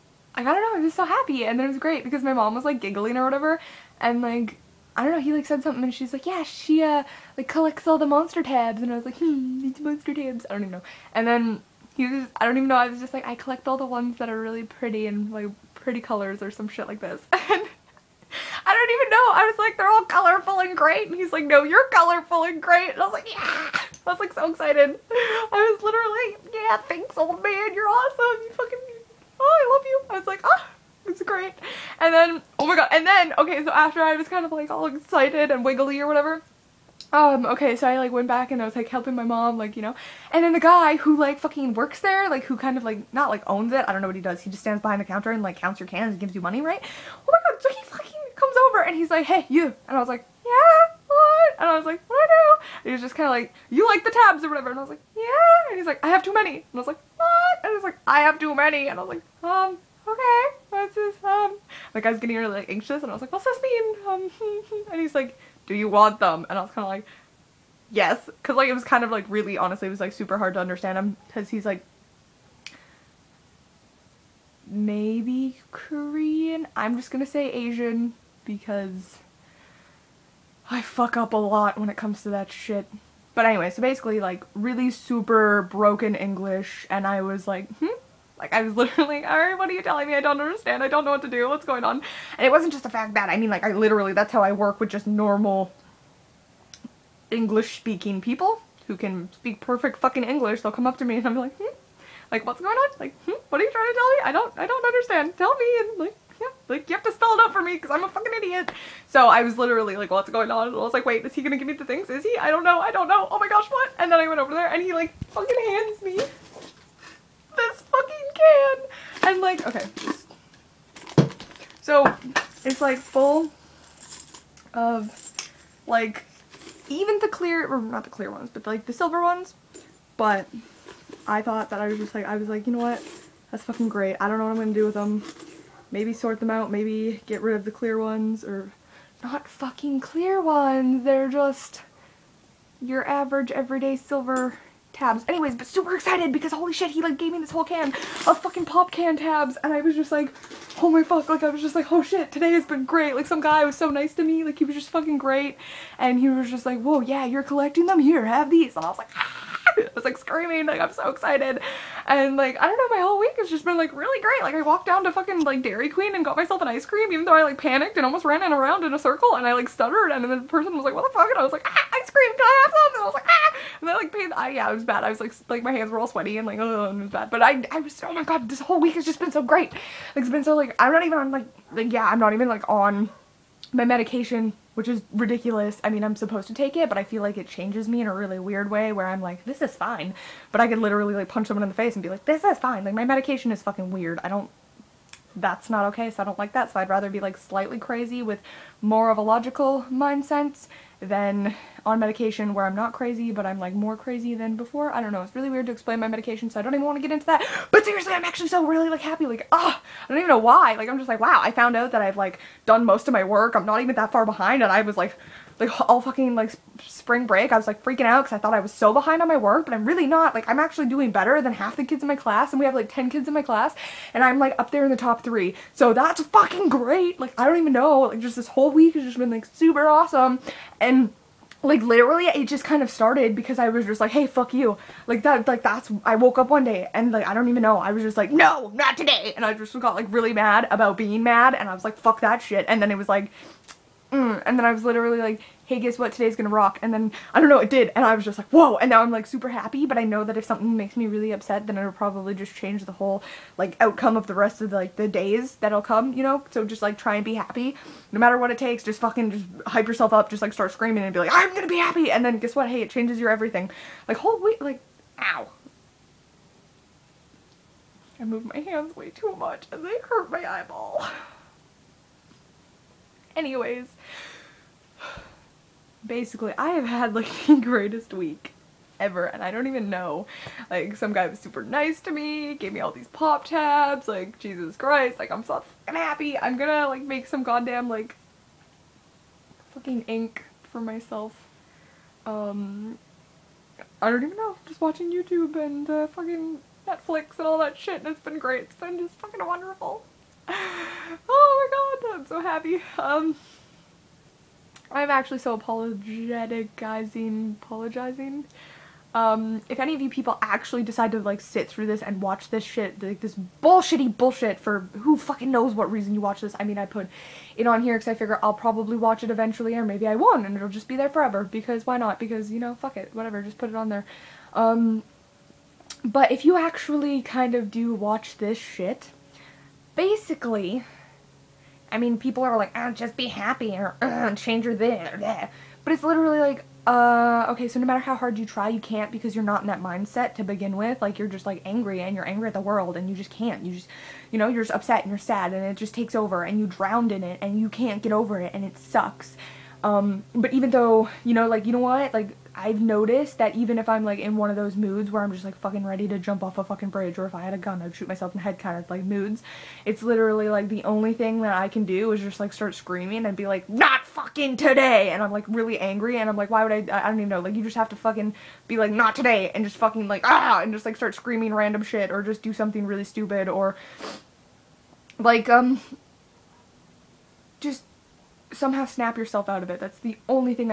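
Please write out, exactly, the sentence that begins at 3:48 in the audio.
Like just this whole week has just been like super awesome.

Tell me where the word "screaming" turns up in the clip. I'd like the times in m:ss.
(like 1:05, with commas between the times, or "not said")
2:40, 4:20, 6:02, 6:11.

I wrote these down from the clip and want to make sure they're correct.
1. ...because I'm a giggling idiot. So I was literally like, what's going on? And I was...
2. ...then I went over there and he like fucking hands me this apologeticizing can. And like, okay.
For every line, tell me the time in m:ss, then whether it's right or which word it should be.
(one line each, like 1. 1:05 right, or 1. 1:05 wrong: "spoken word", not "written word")
1. 1:47 wrong: "fucking", not "giggling"
2. 1:54 wrong: "fucking", not "apologeticizing".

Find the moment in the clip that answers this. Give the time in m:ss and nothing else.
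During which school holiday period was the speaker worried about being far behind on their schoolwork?
3:36.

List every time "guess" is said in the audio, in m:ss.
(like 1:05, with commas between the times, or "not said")
4:05, 4:22.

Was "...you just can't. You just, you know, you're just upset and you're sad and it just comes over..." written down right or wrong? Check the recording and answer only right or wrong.
wrong.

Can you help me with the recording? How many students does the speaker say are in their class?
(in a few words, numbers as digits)
10.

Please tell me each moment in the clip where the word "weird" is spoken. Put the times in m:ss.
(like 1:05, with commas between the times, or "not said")
3:08, 3:13, 3:25.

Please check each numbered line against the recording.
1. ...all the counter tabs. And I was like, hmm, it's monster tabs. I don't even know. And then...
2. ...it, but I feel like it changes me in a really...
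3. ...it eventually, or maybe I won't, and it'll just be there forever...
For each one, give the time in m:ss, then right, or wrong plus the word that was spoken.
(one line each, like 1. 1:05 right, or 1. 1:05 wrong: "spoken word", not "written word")
1. 0:07 wrong: "monster", not "counter"
2. 3:06 right
3. 5:19 right.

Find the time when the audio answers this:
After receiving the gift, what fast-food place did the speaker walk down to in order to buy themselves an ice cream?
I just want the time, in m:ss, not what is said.
2:45.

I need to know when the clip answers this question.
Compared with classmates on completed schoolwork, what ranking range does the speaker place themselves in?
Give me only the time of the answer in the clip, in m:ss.
3:44.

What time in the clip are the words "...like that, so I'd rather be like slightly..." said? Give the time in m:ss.
3:16.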